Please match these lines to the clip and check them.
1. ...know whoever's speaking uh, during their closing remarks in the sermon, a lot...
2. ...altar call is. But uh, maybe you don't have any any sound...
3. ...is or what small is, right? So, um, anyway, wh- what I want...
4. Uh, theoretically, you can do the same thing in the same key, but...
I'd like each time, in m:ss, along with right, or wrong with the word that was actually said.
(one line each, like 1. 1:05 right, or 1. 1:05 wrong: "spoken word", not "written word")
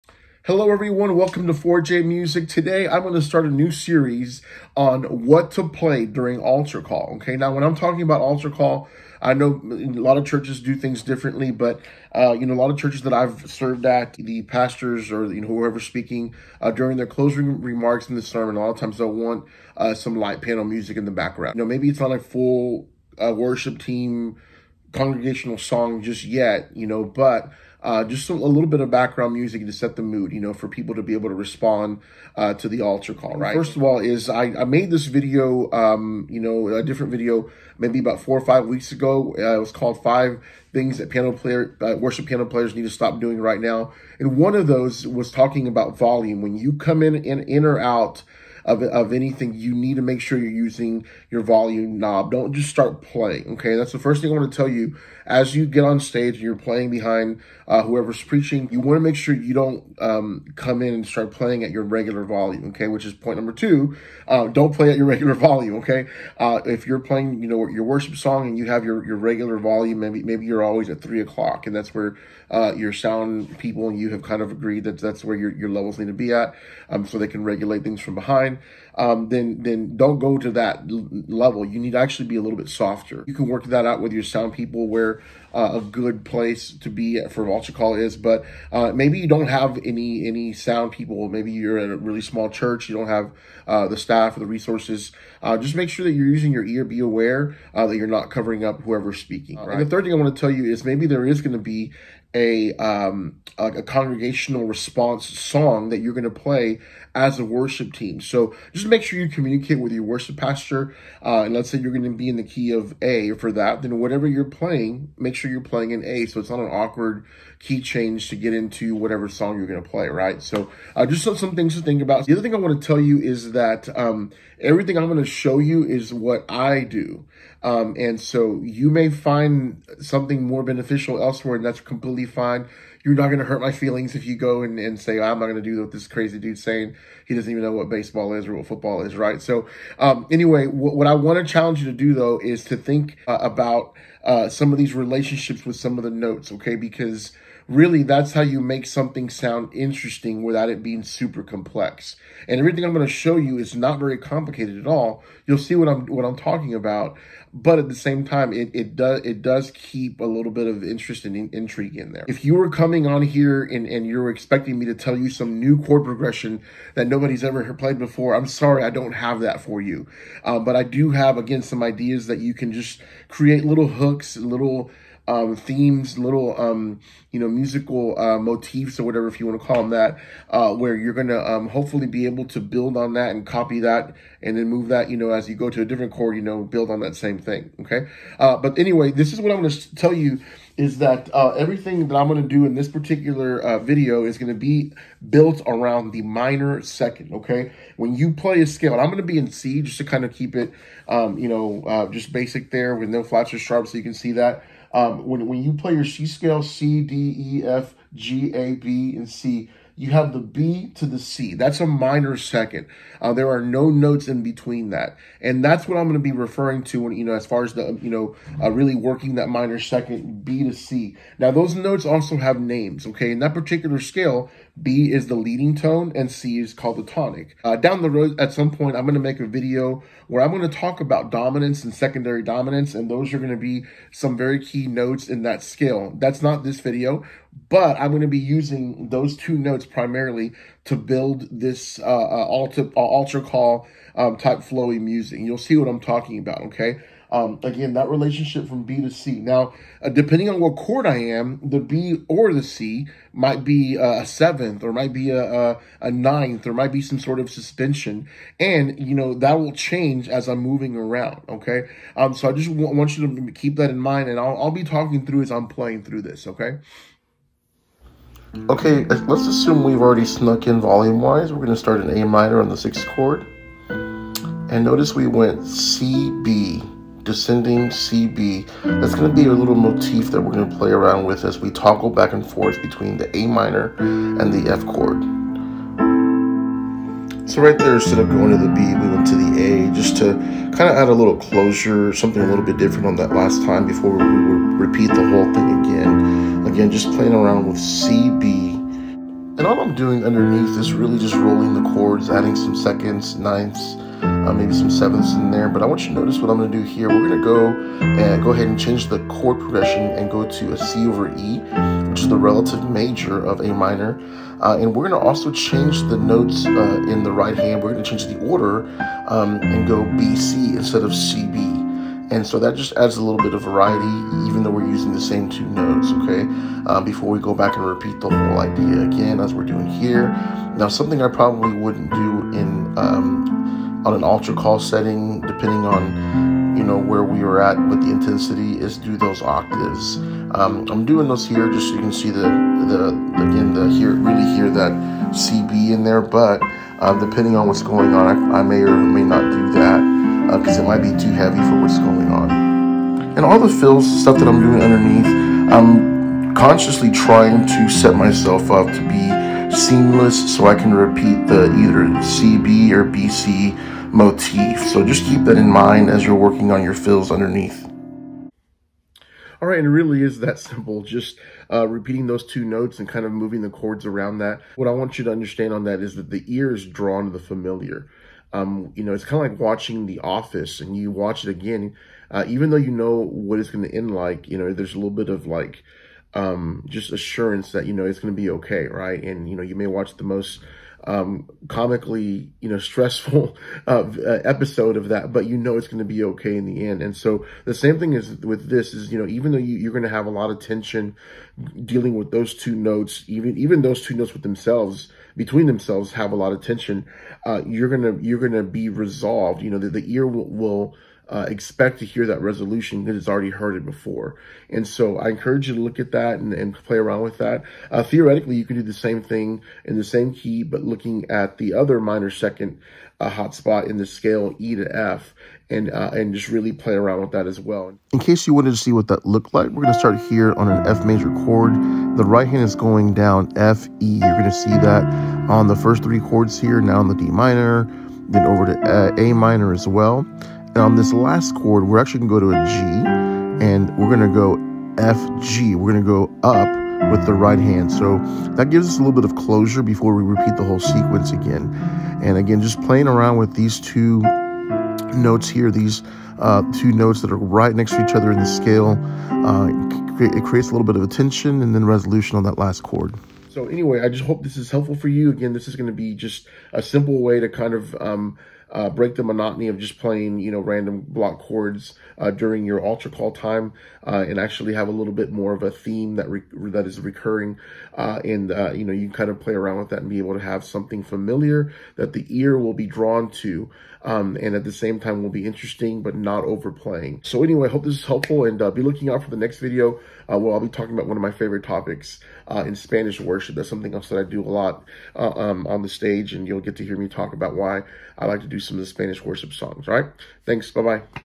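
1. 0:15 right
2. 1:27 right
3. 2:18 wrong: "football", not "small"
4. 6:57 right.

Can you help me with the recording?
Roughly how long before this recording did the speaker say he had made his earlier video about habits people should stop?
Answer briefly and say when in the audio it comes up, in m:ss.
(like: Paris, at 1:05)
4 or 5 weeks ago, at 0:38.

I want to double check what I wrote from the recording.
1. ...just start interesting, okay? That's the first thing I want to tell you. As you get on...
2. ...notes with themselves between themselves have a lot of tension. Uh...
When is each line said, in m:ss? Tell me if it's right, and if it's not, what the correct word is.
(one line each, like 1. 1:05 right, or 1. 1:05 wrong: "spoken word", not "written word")
1. 0:52 wrong: "playing", not "interesting"
2. 6:44 right.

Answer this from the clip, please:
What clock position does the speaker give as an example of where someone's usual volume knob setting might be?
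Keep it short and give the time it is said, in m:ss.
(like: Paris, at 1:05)
3 o'clock, at 1:11.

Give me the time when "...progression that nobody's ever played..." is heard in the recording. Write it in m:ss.
2:46.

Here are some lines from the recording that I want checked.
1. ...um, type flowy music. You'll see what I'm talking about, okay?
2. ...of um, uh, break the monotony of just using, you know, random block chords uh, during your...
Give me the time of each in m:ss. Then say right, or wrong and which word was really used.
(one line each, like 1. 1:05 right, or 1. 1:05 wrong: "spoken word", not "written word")
1. 4:04 right
2. 7:47 wrong: "playing", not "using".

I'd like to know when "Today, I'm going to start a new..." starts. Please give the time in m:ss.
0:02.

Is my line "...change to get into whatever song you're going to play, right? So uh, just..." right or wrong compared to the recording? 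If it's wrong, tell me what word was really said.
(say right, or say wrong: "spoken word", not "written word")
right.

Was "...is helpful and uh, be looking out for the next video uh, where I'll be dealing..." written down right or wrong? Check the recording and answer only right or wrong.
wrong.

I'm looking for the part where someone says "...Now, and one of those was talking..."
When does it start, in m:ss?
0:43.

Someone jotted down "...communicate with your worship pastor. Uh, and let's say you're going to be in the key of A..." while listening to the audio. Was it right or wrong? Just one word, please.
right.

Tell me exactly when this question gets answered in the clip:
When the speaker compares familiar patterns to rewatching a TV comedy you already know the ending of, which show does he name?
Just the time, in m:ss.
6:20.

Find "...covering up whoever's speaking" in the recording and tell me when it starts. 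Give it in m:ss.
1:38.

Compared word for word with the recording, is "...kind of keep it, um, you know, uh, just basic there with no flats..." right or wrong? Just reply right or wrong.
right.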